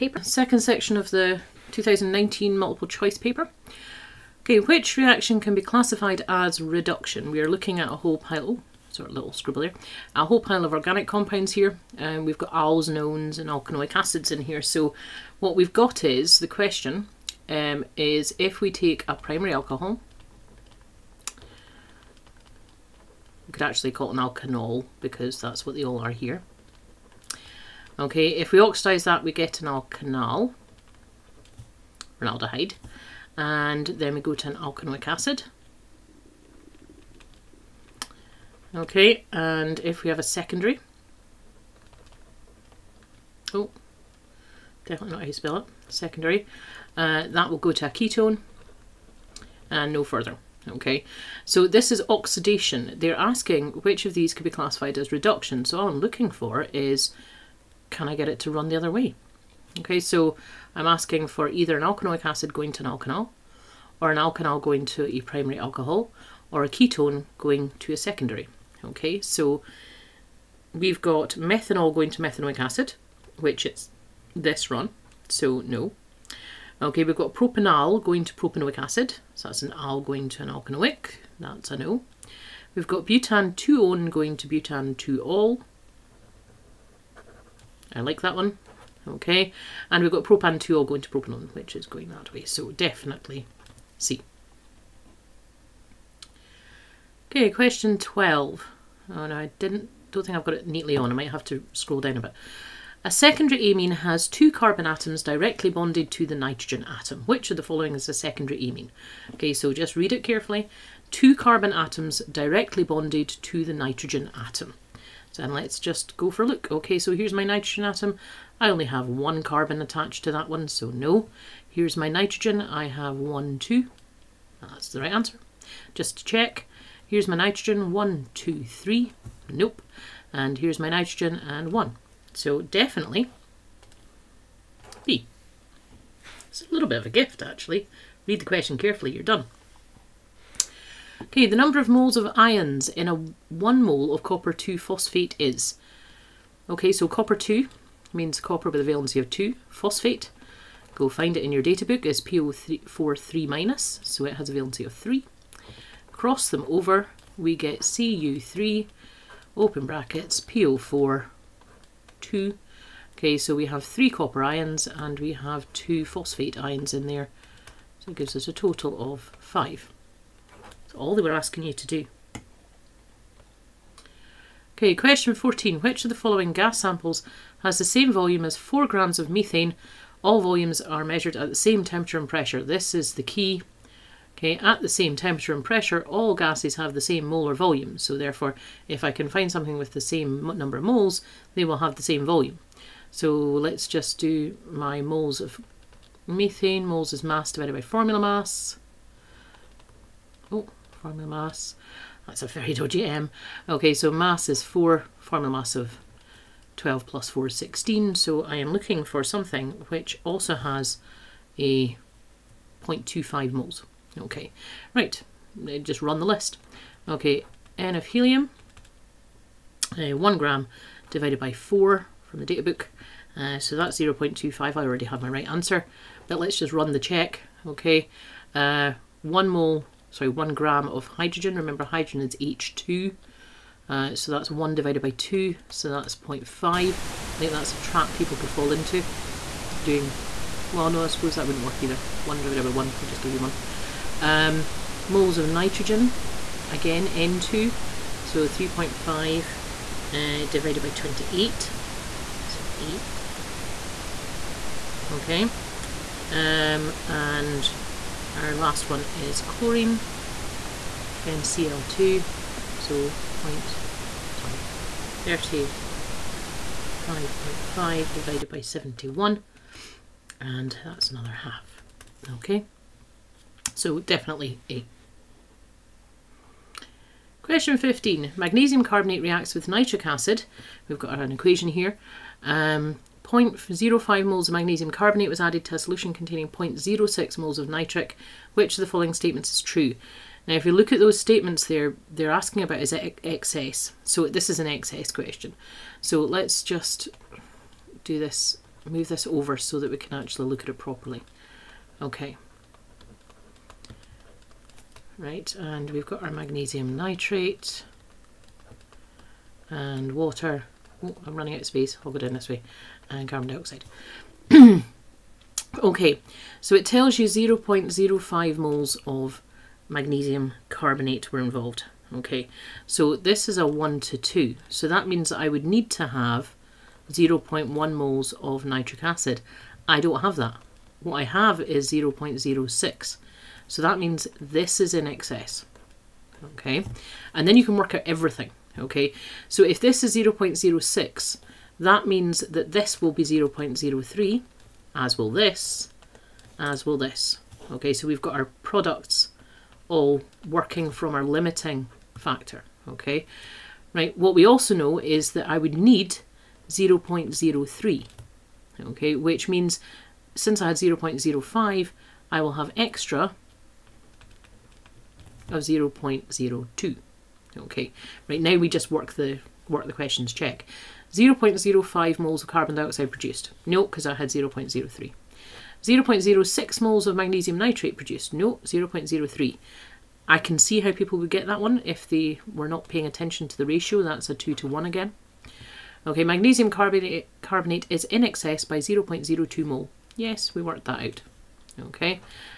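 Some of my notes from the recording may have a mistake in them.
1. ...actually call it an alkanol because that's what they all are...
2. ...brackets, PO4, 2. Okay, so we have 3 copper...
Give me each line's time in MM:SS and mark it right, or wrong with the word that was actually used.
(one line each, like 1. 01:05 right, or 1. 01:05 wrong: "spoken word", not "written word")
1. 00:23 right
2. 02:39 right.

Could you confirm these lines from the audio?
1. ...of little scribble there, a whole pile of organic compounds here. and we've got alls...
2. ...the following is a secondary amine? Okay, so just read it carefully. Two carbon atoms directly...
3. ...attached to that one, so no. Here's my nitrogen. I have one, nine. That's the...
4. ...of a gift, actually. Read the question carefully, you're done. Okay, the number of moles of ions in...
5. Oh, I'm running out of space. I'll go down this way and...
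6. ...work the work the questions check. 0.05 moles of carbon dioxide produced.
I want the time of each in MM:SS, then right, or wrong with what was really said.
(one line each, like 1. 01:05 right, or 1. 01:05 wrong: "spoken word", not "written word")
1. 00:09 right
2. 01:47 right
3. 01:59 wrong: "two", not "nine"
4. 02:16 right
5. 05:11 right
6. 06:08 right.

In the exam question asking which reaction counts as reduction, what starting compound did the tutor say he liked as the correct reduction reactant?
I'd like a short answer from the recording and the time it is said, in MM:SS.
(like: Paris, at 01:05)
butan-2-one, at 01:23.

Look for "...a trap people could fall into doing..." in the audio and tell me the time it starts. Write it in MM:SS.
03:57.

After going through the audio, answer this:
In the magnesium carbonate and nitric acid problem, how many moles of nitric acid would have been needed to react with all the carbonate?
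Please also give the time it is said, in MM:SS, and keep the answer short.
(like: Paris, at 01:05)
0.1, at 05:27.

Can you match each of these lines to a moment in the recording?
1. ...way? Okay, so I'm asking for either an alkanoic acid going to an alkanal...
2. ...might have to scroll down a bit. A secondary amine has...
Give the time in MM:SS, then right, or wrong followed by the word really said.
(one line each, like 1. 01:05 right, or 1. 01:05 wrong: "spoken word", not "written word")
1. 00:58 right
2. 01:41 right.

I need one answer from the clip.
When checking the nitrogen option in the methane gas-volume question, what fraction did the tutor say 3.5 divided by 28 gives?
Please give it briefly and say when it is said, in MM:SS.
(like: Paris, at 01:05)
an eighth, at 04:12.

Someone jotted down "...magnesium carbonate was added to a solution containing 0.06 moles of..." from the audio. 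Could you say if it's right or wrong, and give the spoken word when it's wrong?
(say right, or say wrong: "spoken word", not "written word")
right.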